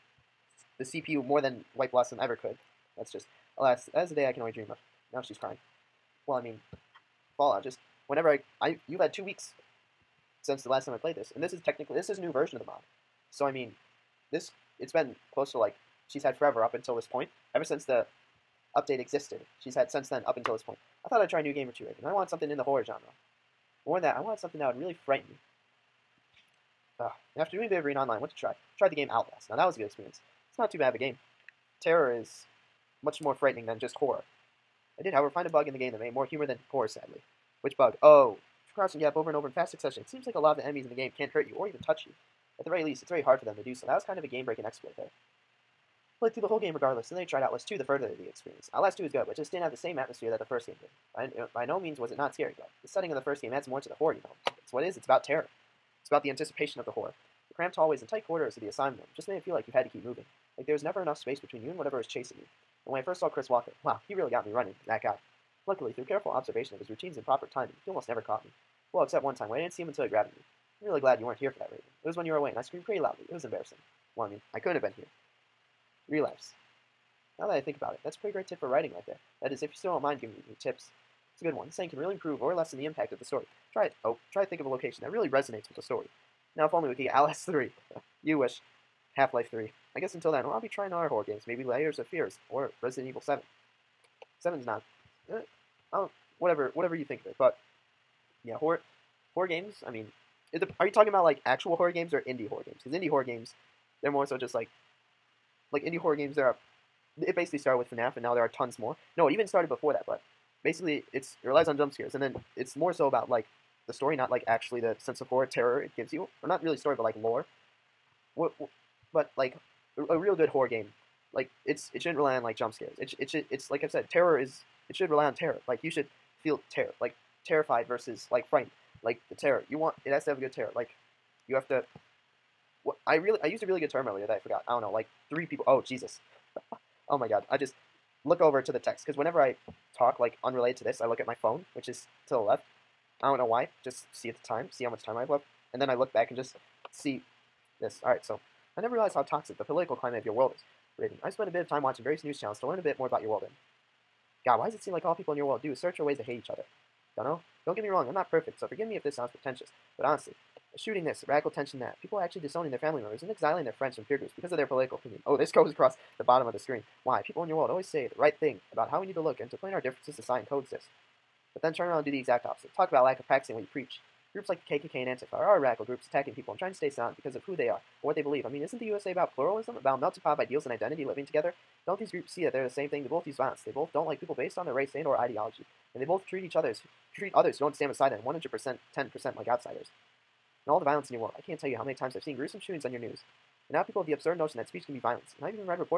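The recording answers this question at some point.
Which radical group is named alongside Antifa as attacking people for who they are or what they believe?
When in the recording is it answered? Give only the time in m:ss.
2:54.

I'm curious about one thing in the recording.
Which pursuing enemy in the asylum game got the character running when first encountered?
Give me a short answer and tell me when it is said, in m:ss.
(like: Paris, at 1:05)
Chris Walker, at 1:03.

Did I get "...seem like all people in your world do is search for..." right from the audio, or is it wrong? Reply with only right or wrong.
right.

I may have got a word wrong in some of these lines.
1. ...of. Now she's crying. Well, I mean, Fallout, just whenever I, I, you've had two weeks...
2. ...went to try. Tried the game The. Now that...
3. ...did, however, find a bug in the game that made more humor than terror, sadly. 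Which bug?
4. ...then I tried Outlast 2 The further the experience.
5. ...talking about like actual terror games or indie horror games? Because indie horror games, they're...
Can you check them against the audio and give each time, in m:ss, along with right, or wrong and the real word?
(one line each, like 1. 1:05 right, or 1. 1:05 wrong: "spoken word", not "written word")
1. 0:04 right
2. 0:28 wrong: "Outlast", not "The"
3. 0:35 wrong: "horror", not "terror"
4. 0:47 right
5. 1:40 wrong: "horror", not "terror".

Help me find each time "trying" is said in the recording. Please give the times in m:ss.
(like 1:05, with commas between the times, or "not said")
1:30, 2:56.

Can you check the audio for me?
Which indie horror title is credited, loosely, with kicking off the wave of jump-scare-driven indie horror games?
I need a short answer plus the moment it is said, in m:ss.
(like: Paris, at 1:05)
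FNAF, at 1:47.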